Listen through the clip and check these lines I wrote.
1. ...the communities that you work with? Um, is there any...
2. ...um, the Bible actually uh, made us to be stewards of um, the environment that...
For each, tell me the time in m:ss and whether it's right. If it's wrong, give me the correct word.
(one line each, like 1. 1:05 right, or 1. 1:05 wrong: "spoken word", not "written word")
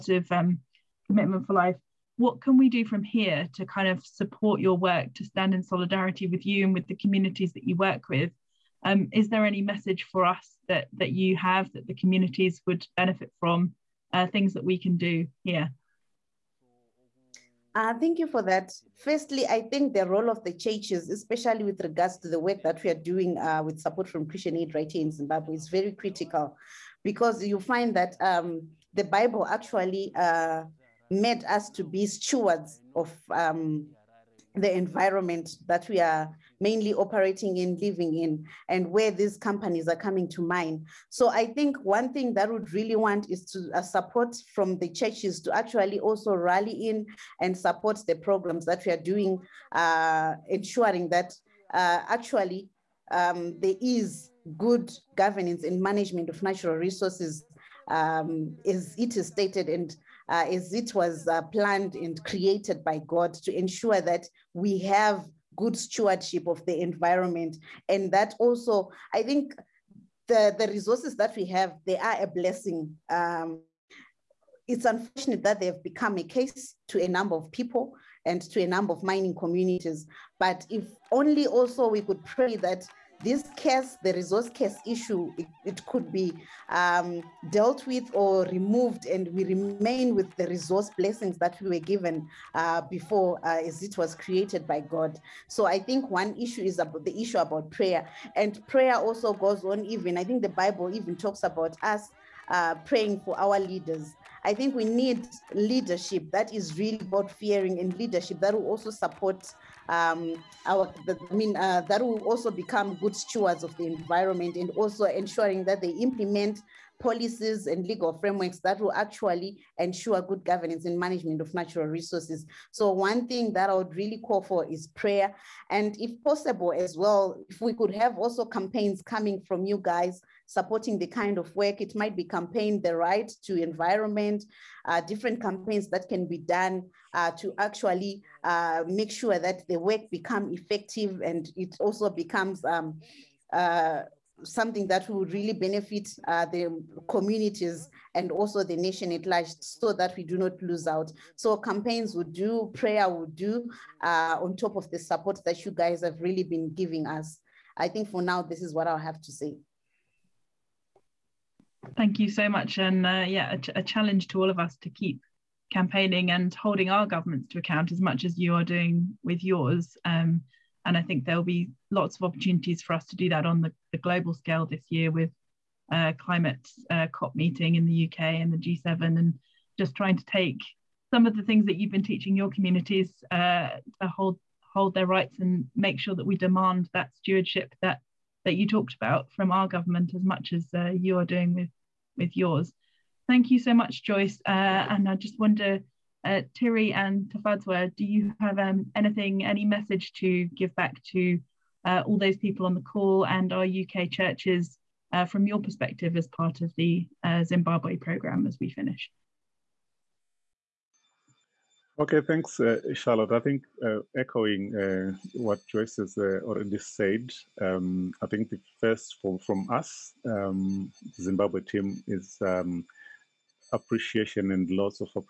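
1. 0:06 right
2. 0:28 right.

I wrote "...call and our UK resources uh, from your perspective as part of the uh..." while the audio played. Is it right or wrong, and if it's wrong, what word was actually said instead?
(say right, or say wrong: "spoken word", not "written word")
wrong: "churches", not "resources".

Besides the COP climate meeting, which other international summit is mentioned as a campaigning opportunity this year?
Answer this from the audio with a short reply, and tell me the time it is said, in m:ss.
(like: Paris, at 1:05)
G7, at 2:58.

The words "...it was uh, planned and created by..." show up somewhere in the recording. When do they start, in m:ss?
1:00.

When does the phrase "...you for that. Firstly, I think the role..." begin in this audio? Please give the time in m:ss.
0:18.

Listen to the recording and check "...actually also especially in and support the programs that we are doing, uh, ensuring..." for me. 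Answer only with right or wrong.
wrong.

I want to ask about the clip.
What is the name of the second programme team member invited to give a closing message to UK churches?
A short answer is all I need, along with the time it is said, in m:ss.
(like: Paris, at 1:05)
Tafadzwa, at 3:17.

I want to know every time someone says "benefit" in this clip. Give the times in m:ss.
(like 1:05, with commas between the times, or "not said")
0:12, 2:25.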